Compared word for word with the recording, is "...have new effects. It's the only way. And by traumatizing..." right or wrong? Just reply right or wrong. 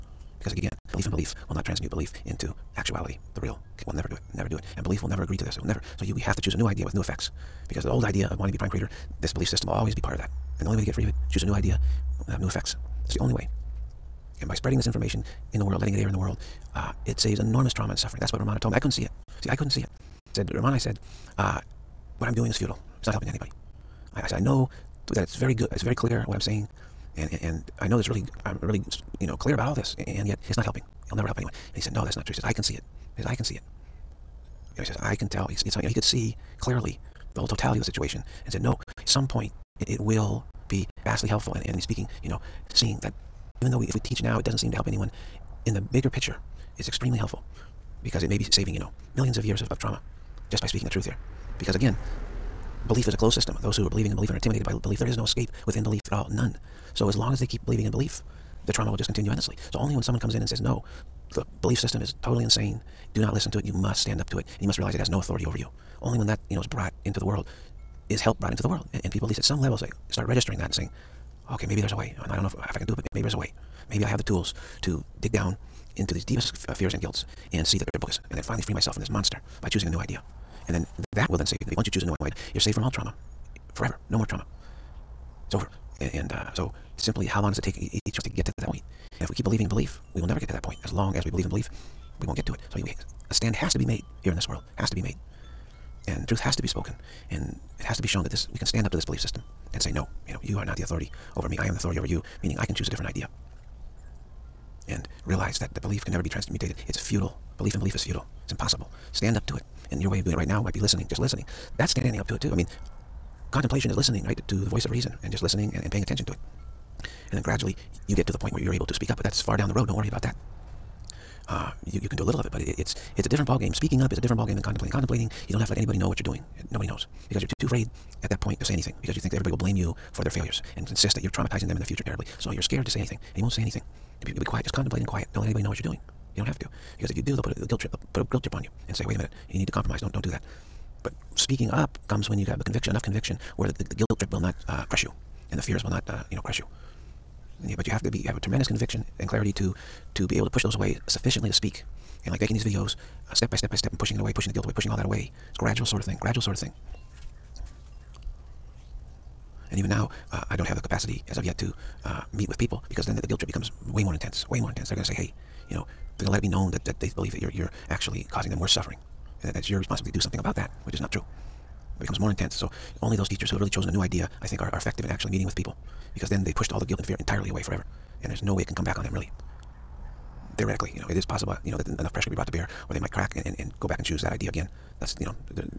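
wrong.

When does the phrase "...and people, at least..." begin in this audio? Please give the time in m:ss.
1:09.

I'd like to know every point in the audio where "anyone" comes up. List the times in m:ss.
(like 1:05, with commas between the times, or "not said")
0:31, 0:44.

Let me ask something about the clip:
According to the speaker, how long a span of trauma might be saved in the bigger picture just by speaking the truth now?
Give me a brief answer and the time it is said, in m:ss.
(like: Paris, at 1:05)
millions of years, at 0:49.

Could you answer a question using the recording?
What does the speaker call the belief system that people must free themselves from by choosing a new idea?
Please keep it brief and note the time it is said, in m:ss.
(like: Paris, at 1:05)
this monster, at 1:19.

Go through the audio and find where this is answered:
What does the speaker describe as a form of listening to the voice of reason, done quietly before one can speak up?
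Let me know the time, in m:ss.
1:53.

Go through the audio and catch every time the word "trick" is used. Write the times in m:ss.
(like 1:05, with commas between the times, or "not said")
not said.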